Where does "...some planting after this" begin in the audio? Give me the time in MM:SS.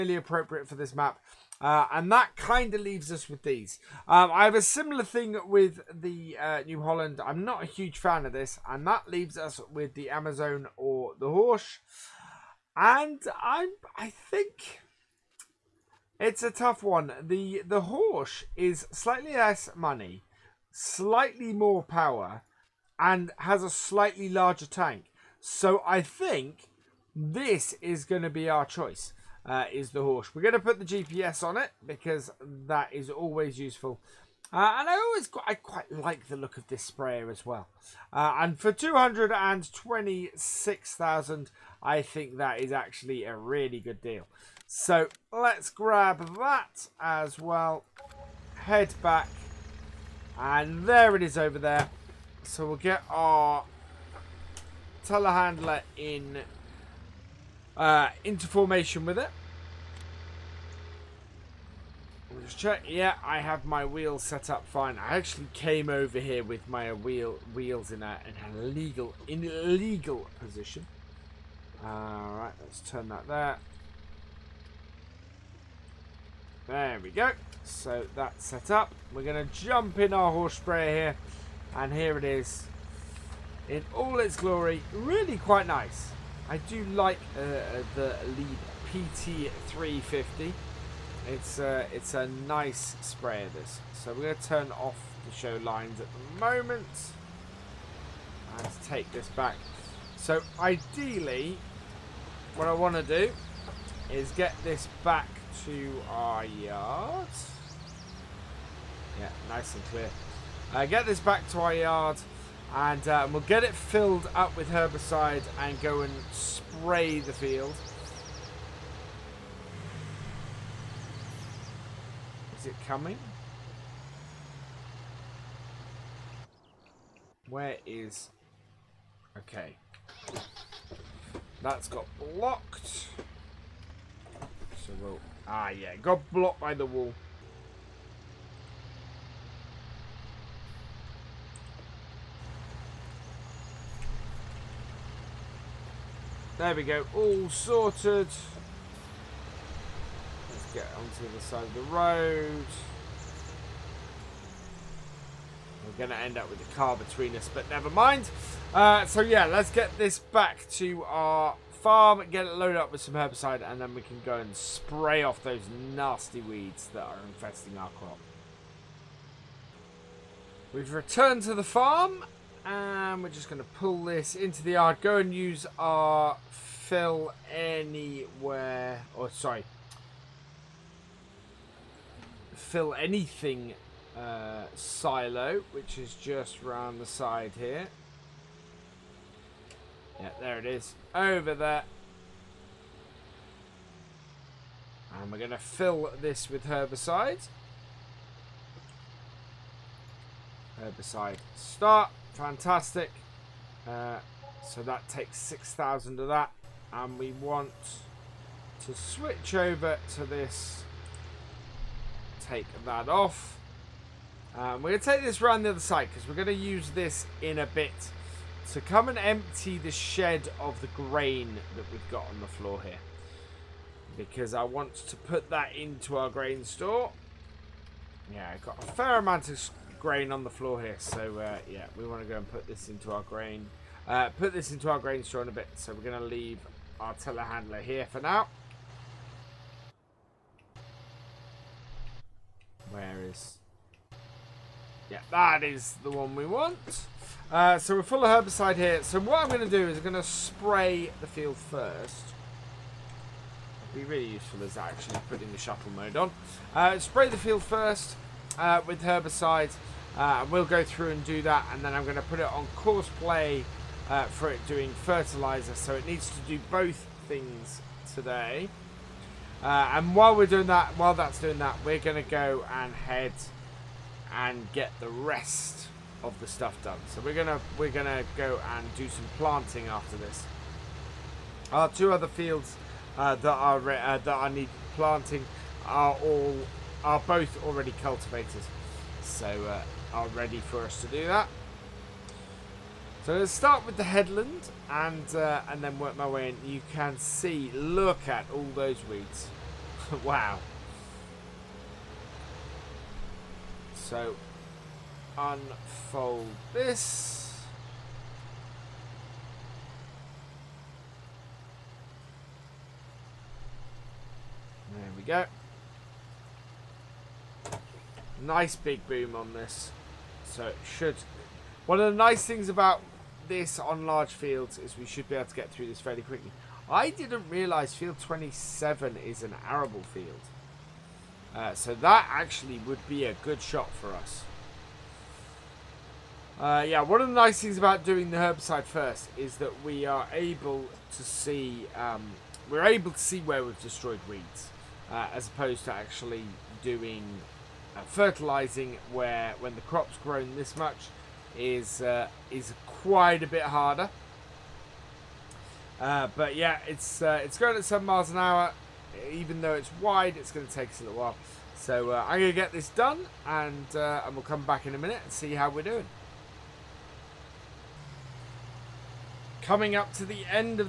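04:39.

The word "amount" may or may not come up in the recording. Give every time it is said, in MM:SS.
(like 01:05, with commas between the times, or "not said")
03:49.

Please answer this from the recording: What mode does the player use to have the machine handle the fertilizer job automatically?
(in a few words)
Course play.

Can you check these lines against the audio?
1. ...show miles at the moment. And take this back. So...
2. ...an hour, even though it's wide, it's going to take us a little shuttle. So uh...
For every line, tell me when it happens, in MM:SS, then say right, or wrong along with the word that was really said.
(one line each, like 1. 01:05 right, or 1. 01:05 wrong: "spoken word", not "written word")
1. 01:35 wrong: "lines", not "miles"
2. 05:58 wrong: "while", not "shuttle".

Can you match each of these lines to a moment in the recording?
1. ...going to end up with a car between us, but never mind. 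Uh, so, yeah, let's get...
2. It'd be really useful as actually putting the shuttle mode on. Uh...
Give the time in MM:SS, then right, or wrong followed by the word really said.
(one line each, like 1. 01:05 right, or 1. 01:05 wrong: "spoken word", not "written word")
1. 02:36 right
2. 04:13 right.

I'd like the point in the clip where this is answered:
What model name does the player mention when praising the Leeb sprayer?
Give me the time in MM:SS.
01:29.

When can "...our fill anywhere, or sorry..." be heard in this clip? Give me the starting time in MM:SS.
02:55.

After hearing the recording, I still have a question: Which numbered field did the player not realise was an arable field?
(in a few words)
Field 27.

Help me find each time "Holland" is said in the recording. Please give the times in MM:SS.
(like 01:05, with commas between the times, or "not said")
00:06.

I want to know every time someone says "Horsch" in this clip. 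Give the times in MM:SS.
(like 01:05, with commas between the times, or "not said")
00:11, 00:17, 00:30, 01:20.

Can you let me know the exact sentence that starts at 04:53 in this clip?
So let's start with the headland and uh, and then work my way in.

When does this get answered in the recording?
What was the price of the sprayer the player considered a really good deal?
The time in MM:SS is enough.
00:38.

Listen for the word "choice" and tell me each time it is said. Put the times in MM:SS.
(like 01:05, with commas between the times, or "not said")
00:28.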